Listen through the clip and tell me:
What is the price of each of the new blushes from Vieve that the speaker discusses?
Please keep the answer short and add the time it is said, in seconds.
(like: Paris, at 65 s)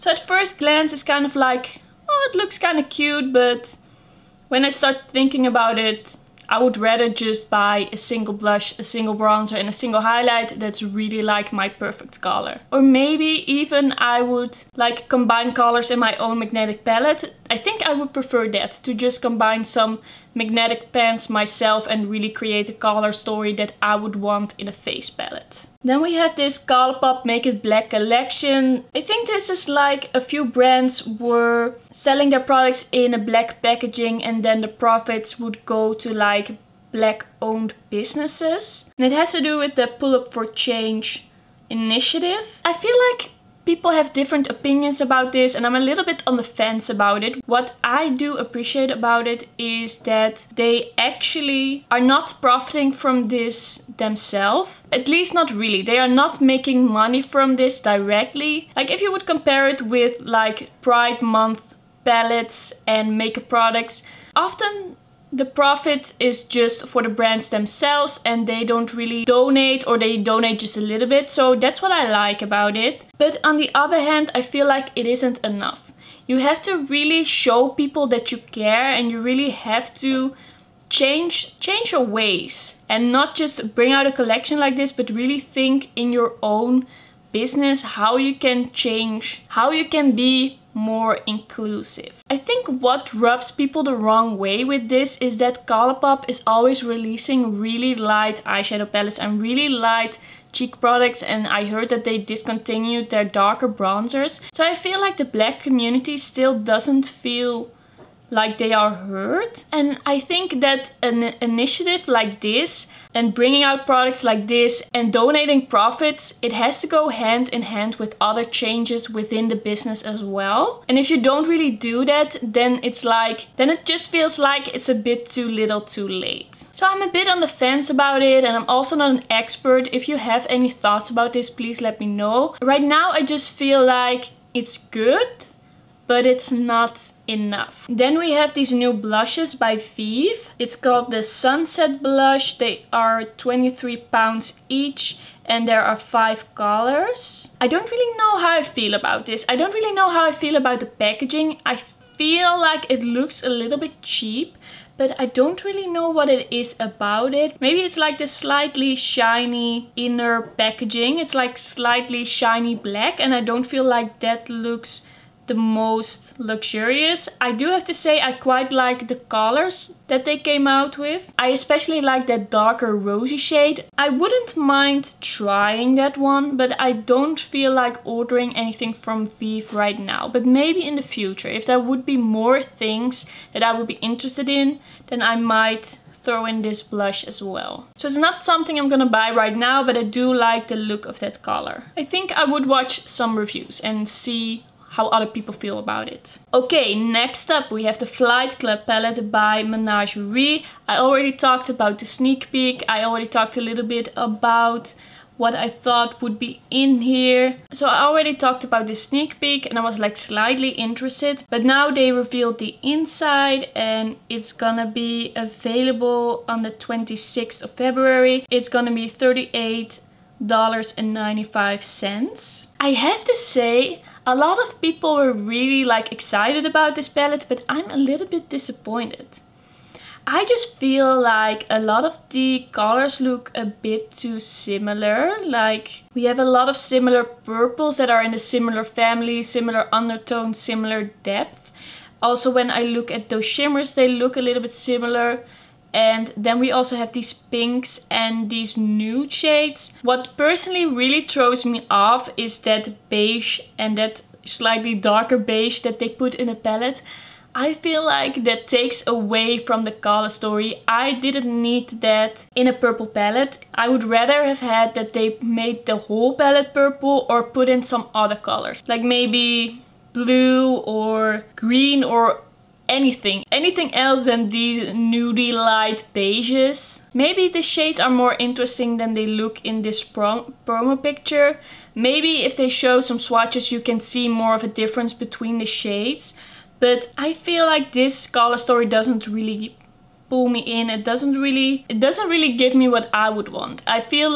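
23 pounds, at 143 s.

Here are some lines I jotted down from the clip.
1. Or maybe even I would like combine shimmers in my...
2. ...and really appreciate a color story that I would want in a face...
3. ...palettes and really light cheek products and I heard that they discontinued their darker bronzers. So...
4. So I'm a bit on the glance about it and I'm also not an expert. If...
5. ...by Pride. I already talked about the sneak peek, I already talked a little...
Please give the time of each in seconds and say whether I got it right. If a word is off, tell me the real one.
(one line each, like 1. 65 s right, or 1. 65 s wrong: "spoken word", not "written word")
1. 12 s wrong: "colors", not "shimmers"
2. 21 s wrong: "create", not "appreciate"
3. 98 s right
4. 126 s wrong: "fence", not "glance"
5. 199 s wrong: "Menagerie", not "Pride".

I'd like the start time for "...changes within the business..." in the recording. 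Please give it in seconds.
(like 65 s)
118 s.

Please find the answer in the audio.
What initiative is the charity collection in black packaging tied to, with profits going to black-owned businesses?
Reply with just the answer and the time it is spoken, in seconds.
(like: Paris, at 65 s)
Pull Up For Change, at 39 s.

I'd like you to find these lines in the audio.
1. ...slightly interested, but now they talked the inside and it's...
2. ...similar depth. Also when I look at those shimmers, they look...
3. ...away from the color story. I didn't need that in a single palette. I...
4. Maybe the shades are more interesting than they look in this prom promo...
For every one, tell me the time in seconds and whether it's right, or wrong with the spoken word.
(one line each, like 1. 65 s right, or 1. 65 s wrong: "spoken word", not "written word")
1. 210 s wrong: "revealed", not "talked"
2. 240 s right
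3. 259 s wrong: "purple", not "single"
4. 277 s right.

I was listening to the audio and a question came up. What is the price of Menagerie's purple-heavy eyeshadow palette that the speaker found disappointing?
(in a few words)
$38.95.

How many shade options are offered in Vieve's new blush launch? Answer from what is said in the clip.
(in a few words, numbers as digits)
5.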